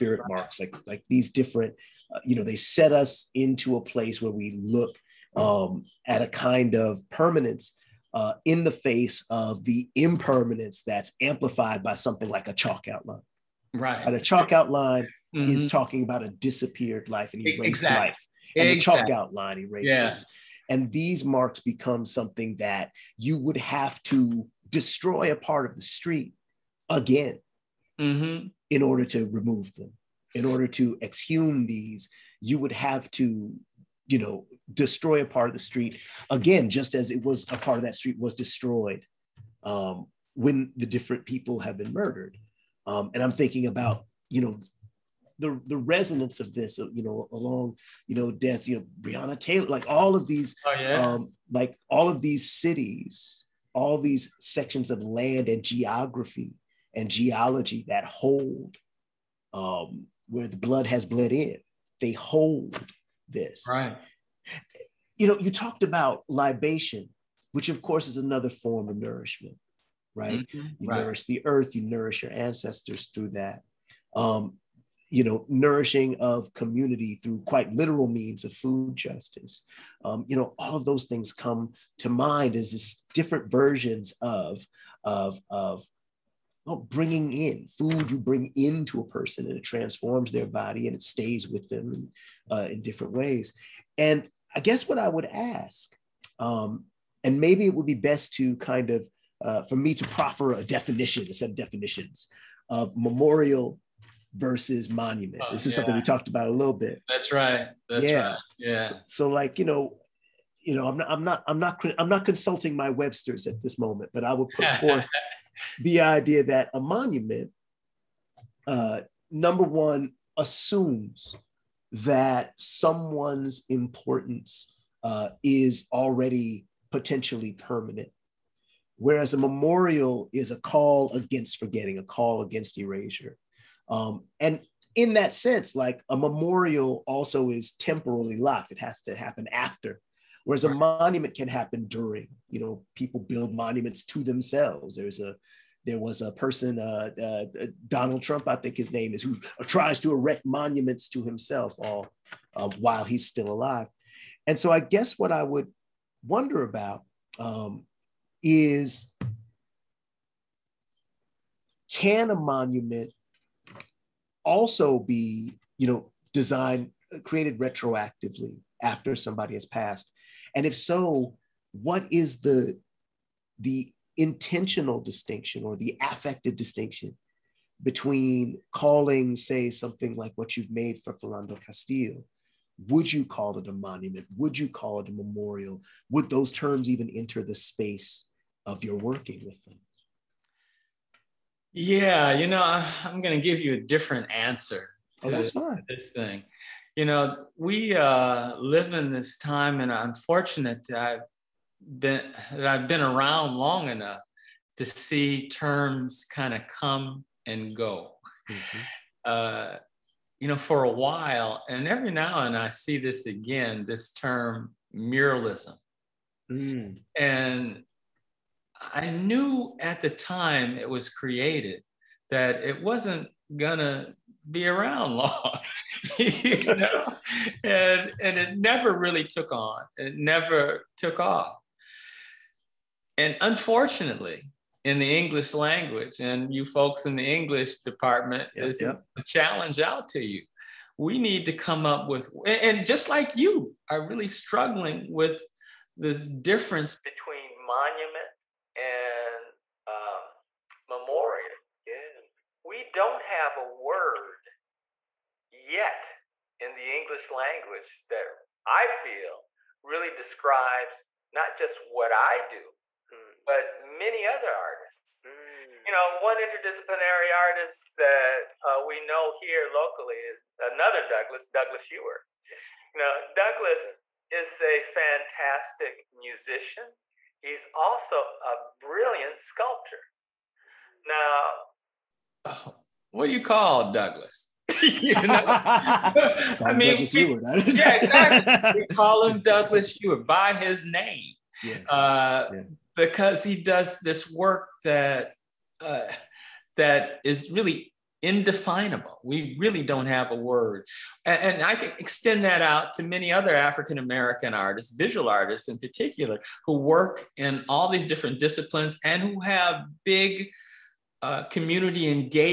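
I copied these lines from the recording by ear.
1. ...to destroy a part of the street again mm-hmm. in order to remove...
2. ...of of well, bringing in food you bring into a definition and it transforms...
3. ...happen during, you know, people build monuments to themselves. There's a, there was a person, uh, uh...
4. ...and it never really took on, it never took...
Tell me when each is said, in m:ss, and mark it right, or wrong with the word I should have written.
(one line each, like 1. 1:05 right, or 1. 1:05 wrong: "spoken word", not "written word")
1. 0:24 right
2. 1:25 wrong: "person", not "definition"
3. 2:21 right
4. 3:48 right.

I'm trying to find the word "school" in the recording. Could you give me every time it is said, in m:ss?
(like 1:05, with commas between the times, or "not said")
not said.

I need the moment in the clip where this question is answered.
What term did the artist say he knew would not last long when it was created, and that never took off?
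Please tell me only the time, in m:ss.
3:34.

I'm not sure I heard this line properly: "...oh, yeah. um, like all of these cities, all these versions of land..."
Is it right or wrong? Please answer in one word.
wrong.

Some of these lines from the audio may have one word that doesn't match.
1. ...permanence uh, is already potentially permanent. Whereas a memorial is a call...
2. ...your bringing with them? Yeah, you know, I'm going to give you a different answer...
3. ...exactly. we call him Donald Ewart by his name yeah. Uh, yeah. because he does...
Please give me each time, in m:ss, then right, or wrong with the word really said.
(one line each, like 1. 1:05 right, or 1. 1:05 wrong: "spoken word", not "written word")
1. 2:03 wrong: "importance", not "permanence"
2. 3:08 wrong: "working", not "bringing"
3. 4:47 wrong: "Douglas", not "Donald".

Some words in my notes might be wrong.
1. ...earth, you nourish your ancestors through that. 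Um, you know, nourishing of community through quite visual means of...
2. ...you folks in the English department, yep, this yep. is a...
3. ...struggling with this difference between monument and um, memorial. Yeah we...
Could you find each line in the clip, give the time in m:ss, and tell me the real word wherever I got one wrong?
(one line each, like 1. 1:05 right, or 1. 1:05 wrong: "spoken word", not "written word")
1. 1:11 wrong: "literal", not "visual"
2. 3:56 right
3. 4:04 right.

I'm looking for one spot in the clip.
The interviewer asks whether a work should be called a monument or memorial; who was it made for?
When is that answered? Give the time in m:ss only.
3:01.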